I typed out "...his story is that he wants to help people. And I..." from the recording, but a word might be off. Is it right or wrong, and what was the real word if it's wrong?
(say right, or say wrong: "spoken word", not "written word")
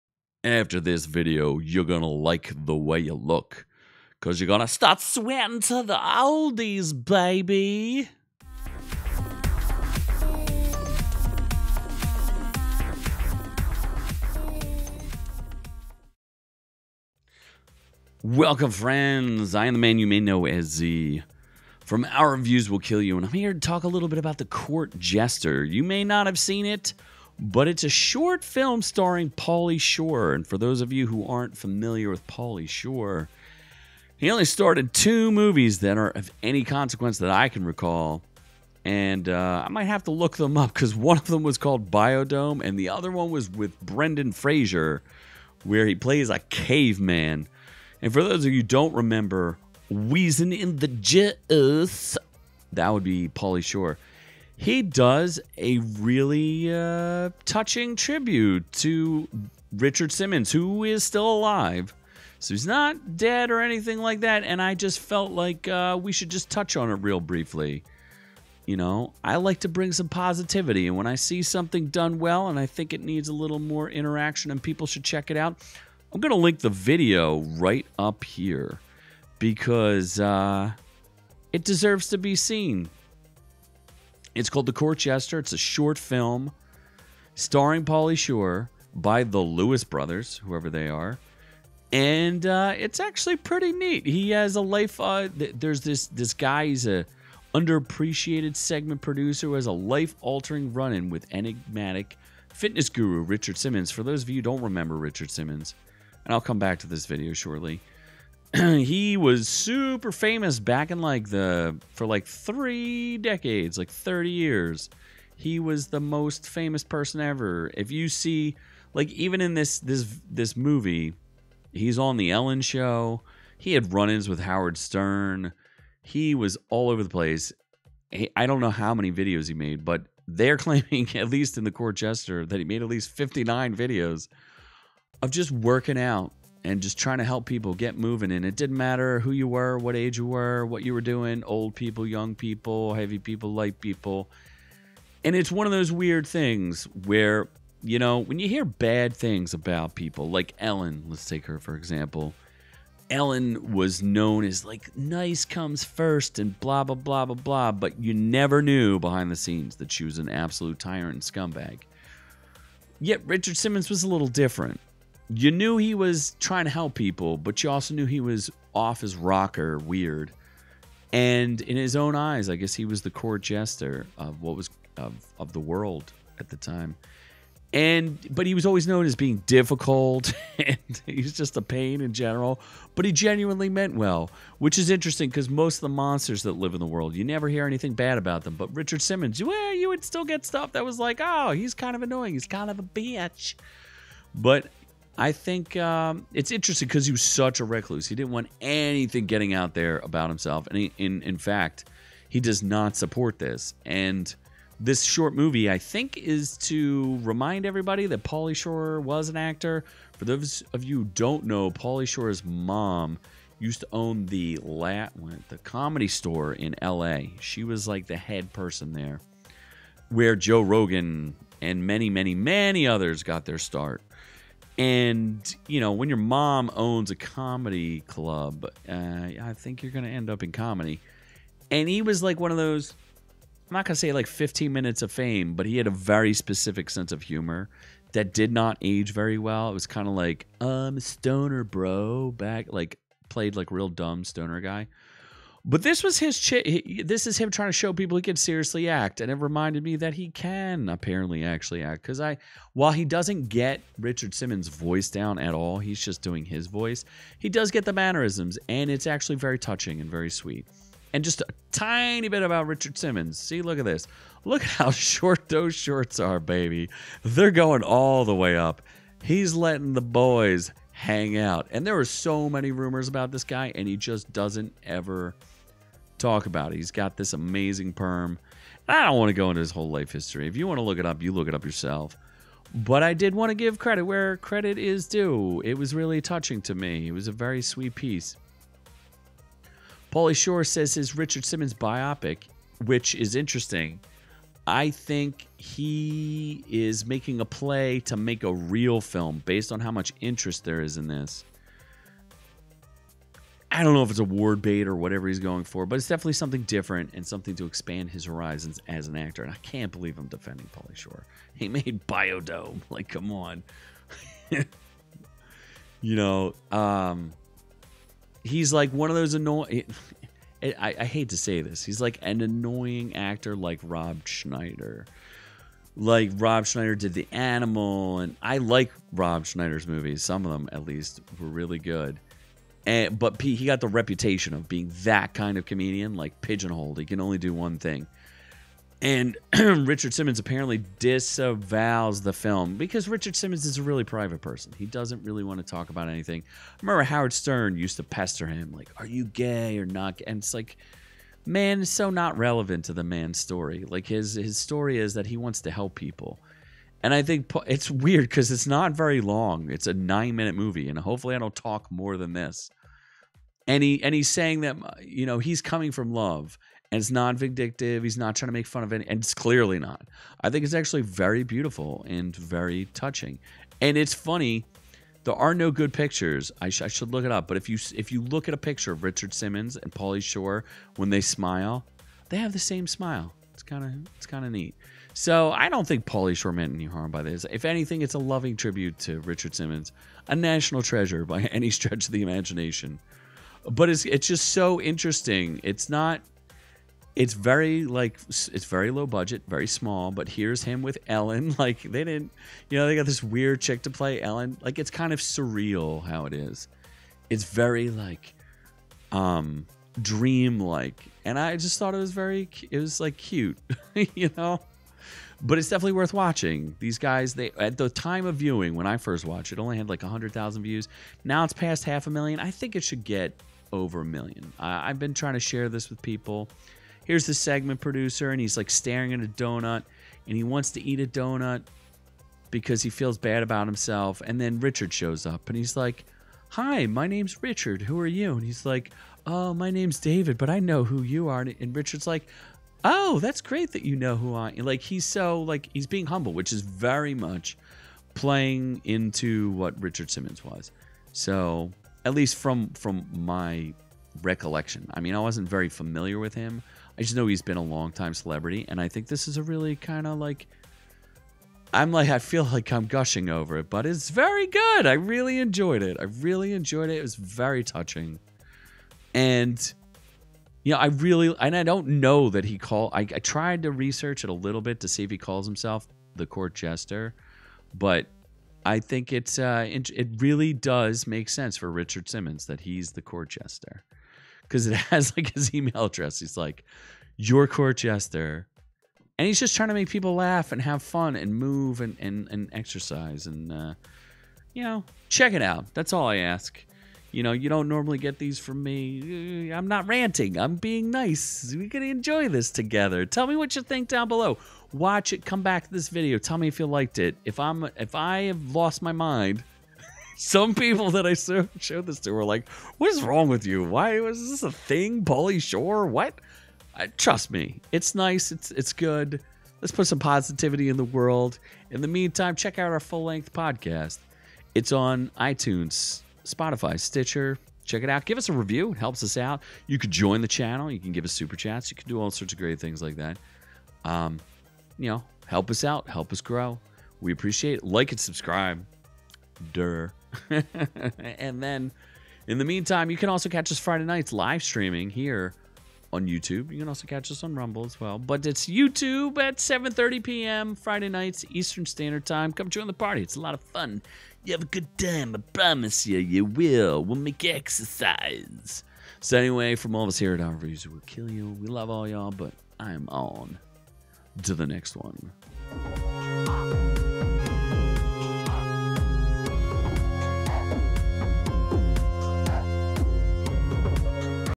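right.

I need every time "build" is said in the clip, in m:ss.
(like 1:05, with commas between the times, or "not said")
not said.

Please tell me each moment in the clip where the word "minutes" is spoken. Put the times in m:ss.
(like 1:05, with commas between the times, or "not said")
3:54, 6:00.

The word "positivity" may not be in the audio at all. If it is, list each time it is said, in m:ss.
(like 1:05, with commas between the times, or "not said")
1:10, 8:39.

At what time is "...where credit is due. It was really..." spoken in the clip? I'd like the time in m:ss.
4:44.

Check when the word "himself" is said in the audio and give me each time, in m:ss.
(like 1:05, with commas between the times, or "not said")
3:20, 7:13, 7:55.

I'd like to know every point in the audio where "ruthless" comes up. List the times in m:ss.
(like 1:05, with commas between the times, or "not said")
not said.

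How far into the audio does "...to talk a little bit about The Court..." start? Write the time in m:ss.
0:23.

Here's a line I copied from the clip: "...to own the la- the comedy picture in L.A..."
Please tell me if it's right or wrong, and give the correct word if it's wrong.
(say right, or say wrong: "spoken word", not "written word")
wrong: "store", not "picture".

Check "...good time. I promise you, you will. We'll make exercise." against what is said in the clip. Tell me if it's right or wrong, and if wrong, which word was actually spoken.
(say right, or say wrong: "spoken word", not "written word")
right.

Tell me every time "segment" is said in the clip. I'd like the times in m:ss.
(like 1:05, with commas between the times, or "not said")
1:38, 7:07.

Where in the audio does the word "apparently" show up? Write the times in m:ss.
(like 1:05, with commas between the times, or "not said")
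4:10, 5:40.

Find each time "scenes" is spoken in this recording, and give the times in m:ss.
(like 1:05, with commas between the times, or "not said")
2:39.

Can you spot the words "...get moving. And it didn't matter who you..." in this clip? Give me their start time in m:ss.
2:17.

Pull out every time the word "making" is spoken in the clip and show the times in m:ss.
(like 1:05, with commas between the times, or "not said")
4:57.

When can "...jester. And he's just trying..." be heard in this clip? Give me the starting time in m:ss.
8:07.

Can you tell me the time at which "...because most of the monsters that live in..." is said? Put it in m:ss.
3:05.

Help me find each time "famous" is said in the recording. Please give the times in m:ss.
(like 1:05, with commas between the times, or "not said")
1:50, 1:56.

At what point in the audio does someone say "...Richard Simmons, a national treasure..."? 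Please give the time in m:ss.
6:29.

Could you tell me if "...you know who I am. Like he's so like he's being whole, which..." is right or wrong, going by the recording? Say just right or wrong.
wrong.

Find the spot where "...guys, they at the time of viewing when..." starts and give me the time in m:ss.
6:56.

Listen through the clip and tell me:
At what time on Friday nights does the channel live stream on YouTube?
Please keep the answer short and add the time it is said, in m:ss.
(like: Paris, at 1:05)
7:30 p.m., at 9:09.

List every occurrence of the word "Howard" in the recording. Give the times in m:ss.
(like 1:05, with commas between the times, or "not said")
2:04, 5:47.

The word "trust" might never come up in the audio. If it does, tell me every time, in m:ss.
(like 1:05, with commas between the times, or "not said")
8:36.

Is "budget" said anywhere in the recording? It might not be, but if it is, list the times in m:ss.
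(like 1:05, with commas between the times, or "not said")
6:39.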